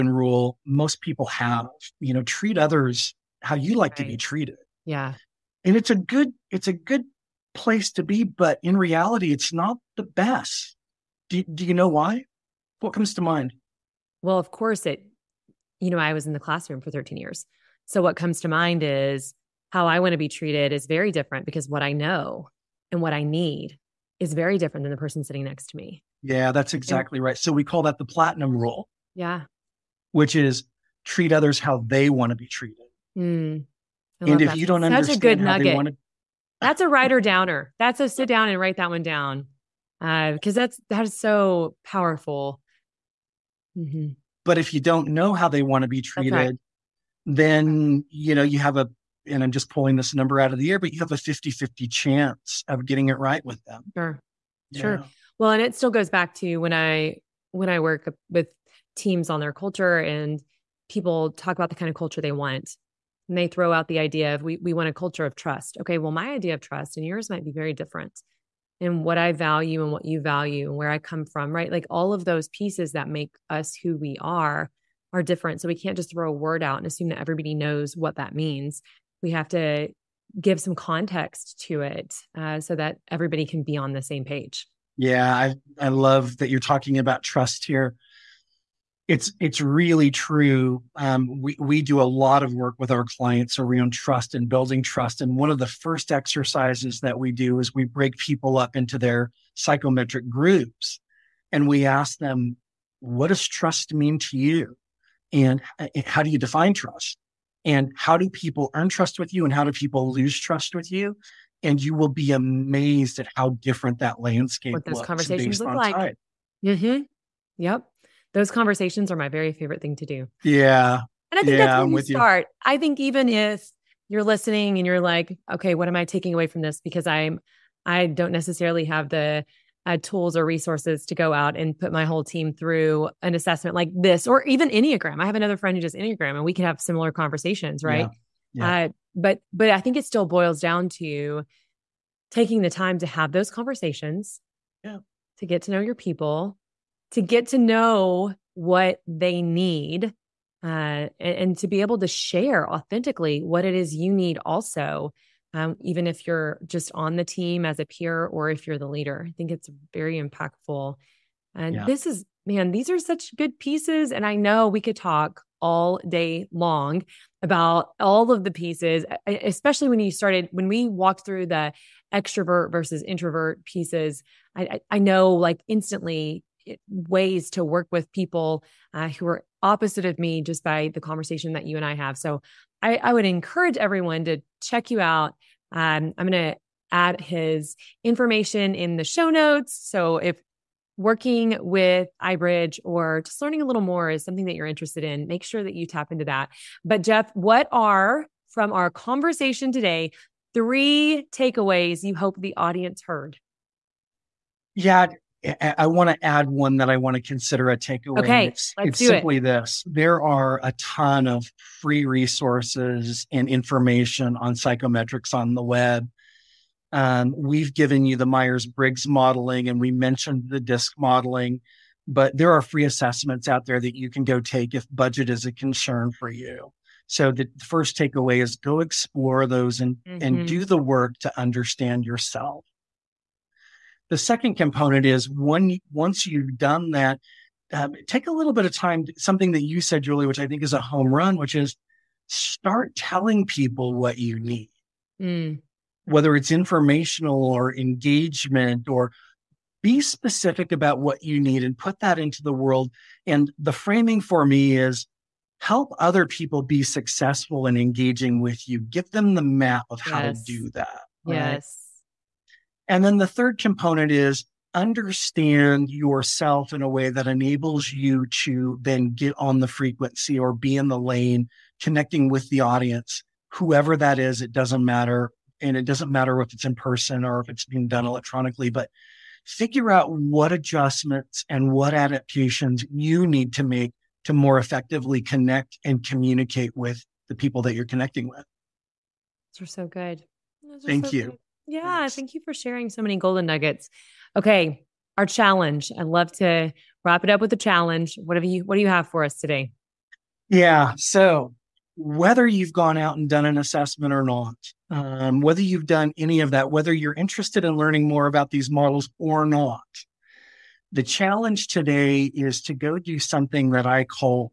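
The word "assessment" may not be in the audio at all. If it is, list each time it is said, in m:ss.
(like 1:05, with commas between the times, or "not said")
2:13, 3:42, 5:03.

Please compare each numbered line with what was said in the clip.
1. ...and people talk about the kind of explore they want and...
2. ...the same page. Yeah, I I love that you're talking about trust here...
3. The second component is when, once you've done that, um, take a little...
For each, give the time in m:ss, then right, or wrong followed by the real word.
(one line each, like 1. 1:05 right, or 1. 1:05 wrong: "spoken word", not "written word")
1. 0:59 wrong: "culture", not "explore"
2. 1:23 right
3. 3:54 right.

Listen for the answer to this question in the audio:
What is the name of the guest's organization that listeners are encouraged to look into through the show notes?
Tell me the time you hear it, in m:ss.
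3:12.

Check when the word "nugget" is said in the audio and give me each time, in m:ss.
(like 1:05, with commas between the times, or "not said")
0:35, 4:53.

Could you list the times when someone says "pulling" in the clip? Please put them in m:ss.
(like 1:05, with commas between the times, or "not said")
0:49.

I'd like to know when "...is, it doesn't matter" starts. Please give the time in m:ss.
4:34.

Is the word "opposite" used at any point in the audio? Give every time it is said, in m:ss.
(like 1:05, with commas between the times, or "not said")
2:59.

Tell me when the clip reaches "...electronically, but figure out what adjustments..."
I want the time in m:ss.
4:38.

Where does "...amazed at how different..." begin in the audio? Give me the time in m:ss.
1:52.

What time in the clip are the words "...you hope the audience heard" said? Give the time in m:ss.
3:22.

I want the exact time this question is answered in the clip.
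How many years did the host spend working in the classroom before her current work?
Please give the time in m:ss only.
0:16.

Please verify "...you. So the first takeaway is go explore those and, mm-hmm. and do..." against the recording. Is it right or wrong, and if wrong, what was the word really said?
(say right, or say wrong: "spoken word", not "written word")
right.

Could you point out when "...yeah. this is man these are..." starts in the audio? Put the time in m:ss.
2:41.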